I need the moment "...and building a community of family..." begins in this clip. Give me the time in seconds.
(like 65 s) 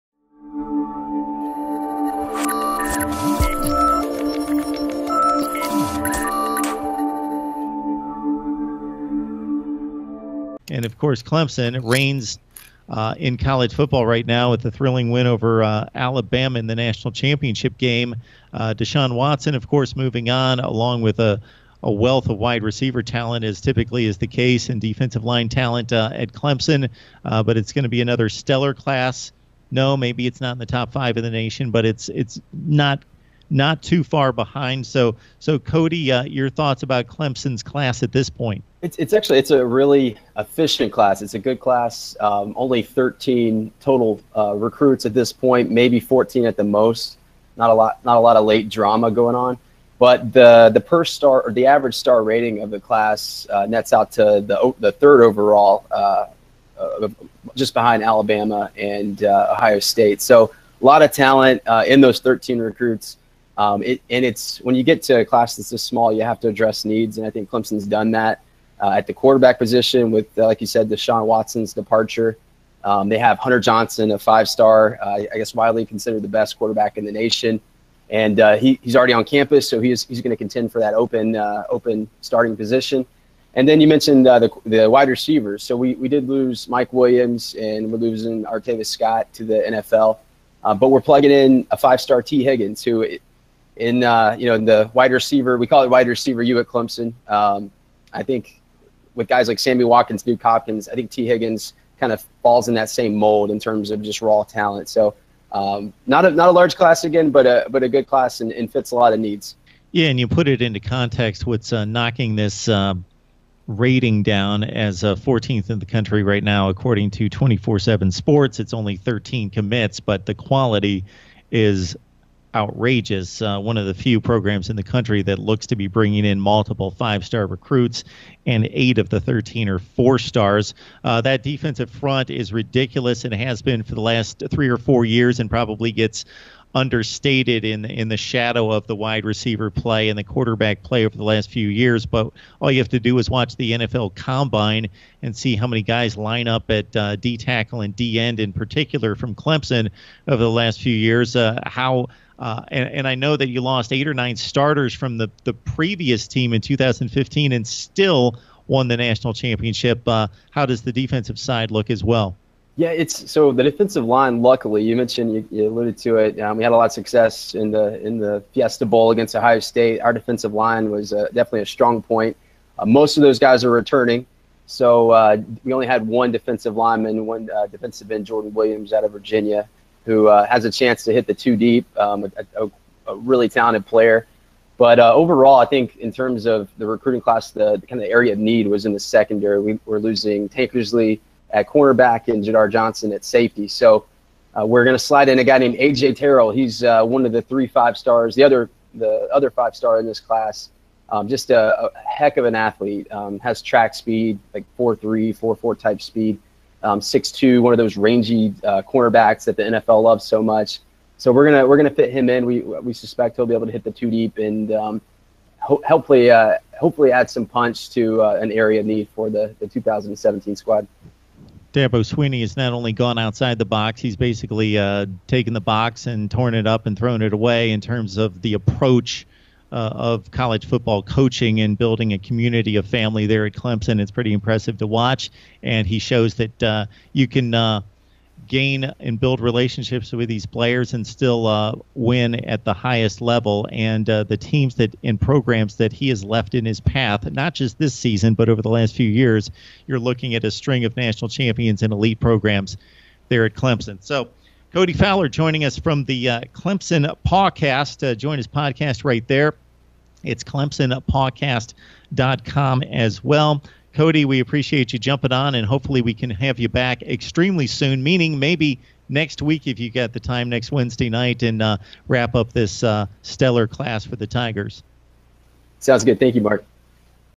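231 s.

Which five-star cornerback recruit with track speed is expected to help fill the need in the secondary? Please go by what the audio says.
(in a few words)
AJ Terrell.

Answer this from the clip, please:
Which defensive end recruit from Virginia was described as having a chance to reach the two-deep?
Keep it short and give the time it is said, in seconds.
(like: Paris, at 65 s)
Jordan Williams, at 178 s.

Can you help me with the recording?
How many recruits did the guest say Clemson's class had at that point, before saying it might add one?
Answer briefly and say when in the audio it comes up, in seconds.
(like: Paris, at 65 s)
13, at 42 s.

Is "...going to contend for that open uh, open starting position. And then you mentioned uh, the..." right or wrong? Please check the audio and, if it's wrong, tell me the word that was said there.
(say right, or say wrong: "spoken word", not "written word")
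right.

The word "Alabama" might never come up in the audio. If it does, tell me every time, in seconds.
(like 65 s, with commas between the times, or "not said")
15 s, 58 s.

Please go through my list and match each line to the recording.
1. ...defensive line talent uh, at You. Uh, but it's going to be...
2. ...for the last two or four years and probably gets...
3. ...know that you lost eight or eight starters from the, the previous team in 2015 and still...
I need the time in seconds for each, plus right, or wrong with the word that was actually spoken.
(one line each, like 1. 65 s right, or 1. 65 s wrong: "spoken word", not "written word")
1. 24 s wrong: "Clemson", not "You"
2. 133 s wrong: "three", not "two"
3. 153 s wrong: "nine", not "eight".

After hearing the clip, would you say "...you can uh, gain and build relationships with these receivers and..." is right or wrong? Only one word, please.
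wrong.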